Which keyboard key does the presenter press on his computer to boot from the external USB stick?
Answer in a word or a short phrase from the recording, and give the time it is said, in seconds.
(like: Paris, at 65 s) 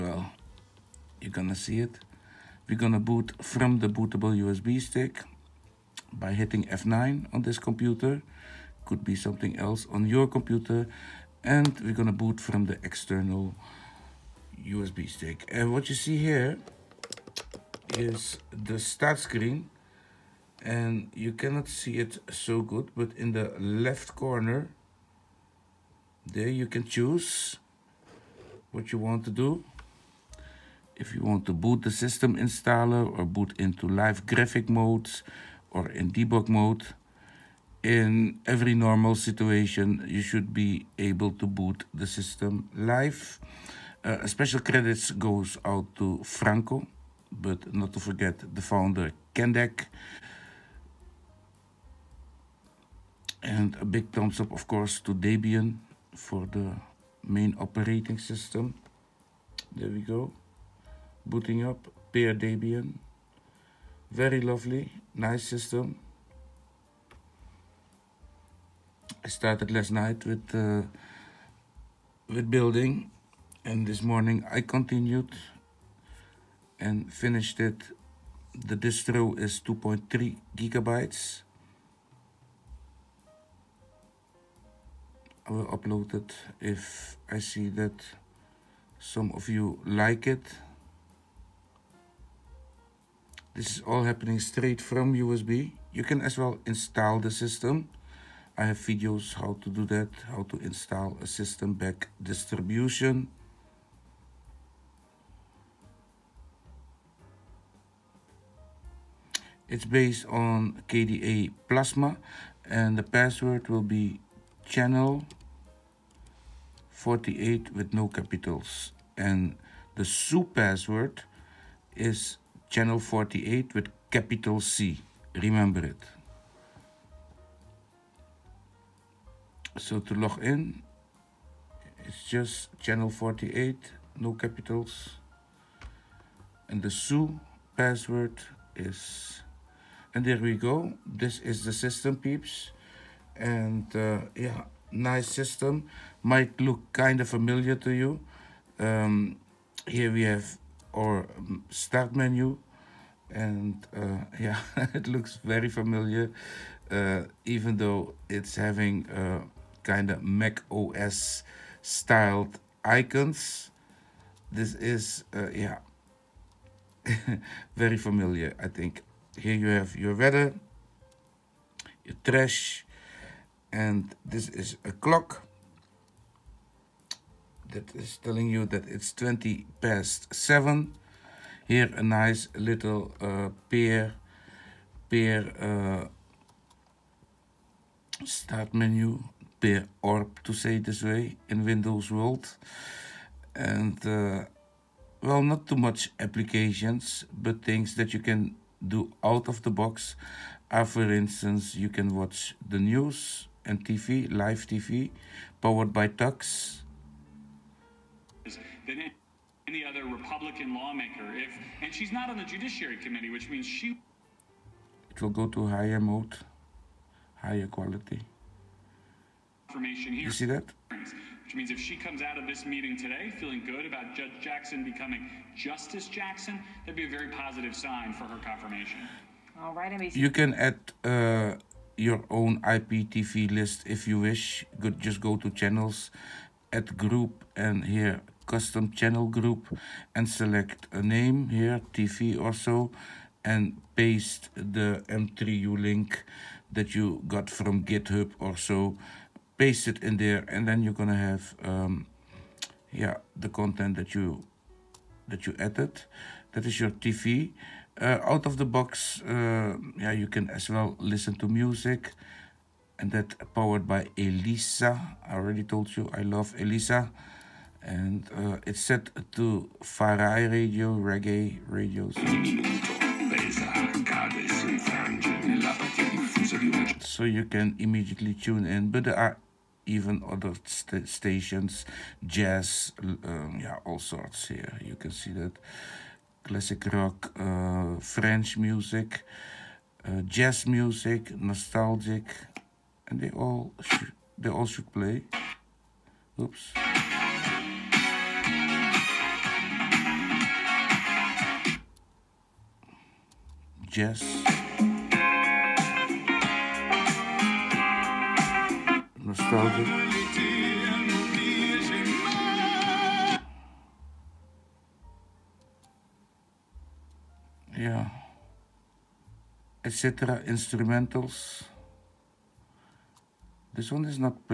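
F9, at 6 s.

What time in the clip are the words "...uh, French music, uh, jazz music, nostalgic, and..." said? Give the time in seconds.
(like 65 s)
287 s.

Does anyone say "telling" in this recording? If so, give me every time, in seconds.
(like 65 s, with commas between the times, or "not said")
178 s.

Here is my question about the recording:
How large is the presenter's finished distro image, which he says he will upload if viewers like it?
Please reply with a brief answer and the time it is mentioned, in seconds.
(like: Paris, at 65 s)
2.3 gigabytes, at 79 s.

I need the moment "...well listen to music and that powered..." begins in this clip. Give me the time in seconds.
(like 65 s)
260 s.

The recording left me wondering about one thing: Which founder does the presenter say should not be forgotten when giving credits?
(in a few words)
Kendek.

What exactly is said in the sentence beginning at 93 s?
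This is all happening straight from USB.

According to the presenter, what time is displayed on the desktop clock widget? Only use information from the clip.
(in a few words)
20 past 7.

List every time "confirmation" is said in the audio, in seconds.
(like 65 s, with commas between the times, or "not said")
219 s, 228 s.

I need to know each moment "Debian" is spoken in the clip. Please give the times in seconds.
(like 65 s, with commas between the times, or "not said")
55 s, 62 s.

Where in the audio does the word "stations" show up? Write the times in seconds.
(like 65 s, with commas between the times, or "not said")
281 s.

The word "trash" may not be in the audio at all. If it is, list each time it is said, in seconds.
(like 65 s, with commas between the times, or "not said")
172 s.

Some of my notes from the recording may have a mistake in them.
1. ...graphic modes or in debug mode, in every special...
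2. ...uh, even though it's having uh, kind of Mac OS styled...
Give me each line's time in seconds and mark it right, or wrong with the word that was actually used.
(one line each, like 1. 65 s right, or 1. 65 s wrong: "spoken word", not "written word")
1. 34 s wrong: "normal", not "special"
2. 156 s right.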